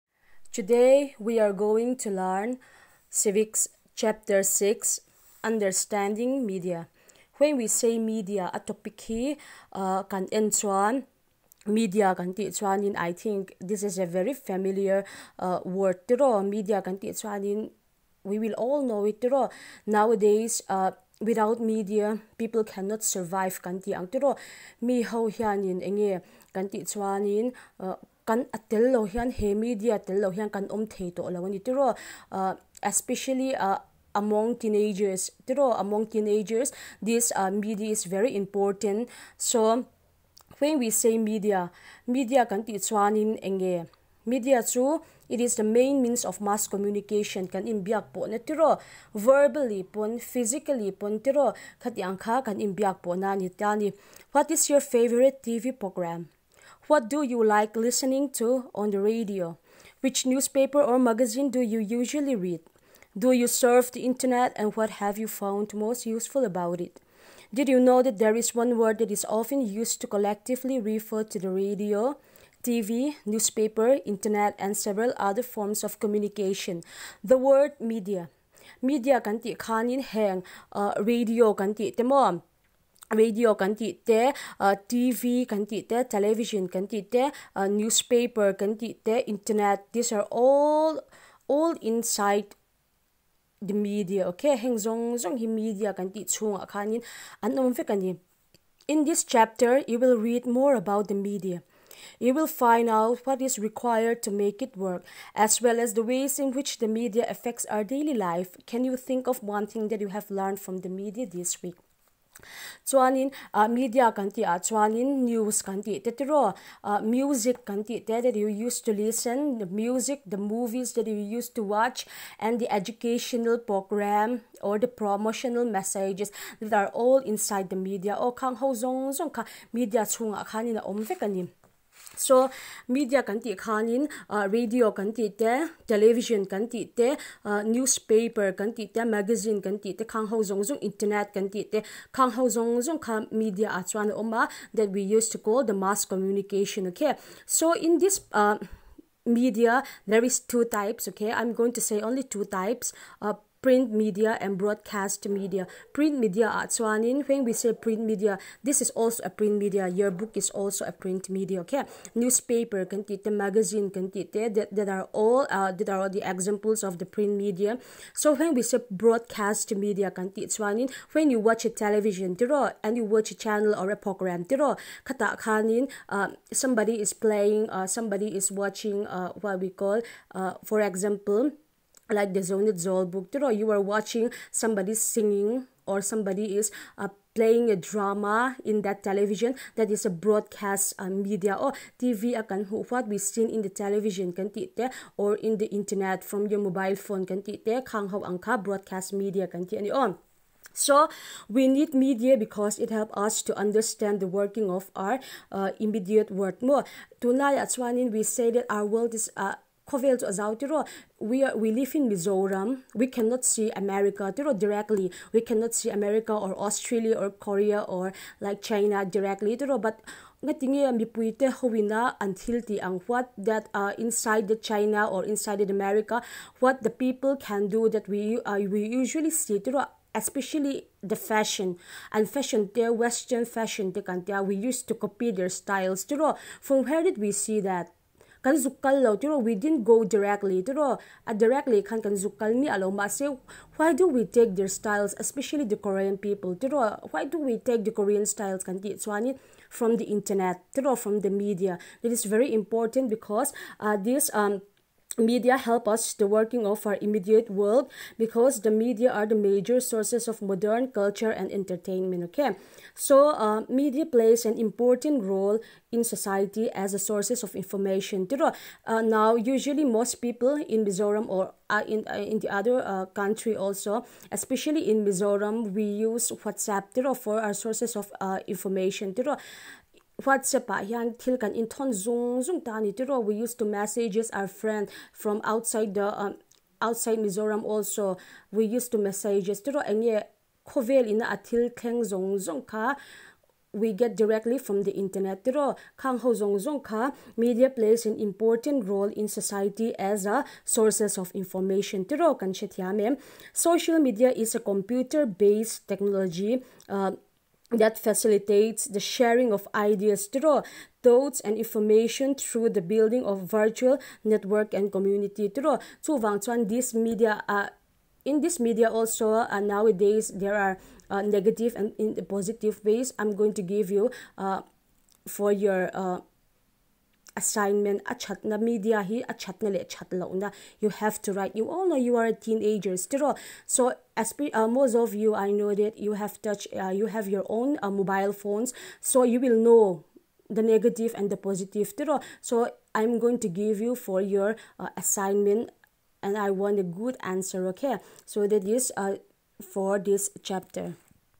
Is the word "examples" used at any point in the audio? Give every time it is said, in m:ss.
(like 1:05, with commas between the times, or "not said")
2:46, 3:00.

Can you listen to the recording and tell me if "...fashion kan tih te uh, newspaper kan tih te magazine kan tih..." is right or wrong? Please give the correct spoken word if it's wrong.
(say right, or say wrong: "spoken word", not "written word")
wrong: "television", not "fashion".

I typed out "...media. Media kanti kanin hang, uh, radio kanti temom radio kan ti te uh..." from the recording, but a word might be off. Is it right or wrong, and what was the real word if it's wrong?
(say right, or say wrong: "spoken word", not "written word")
right.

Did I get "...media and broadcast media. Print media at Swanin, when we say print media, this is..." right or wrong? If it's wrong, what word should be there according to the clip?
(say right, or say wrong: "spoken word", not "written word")
right.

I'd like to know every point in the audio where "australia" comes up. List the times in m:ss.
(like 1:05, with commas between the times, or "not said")
3:36.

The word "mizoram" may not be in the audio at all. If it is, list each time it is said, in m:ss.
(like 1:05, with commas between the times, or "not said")
3:32, 4:30, 4:35, 4:47.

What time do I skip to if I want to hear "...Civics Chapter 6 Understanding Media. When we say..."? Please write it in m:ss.
0:03.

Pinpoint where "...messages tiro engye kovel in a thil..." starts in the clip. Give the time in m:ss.
4:49.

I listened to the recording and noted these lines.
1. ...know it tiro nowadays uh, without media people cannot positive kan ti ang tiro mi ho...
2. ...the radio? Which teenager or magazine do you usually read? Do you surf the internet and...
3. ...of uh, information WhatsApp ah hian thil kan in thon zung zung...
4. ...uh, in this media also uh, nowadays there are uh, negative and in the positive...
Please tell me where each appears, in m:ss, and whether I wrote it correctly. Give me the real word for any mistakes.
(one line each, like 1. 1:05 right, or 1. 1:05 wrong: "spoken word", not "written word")
1. 0:18 wrong: "survive", not "positive"
2. 0:58 wrong: "newspaper", not "teenager"
3. 4:37 right
4. 5:17 right.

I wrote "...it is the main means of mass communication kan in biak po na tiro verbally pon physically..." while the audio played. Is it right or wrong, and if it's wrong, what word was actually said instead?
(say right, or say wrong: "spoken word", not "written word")
right.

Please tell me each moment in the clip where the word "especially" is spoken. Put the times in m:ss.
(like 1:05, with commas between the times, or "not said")
0:32, 3:50, 4:05, 4:34.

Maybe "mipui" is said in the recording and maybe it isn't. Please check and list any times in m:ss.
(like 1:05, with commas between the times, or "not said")
3:40.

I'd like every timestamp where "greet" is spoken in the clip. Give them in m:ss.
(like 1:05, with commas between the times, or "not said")
not said.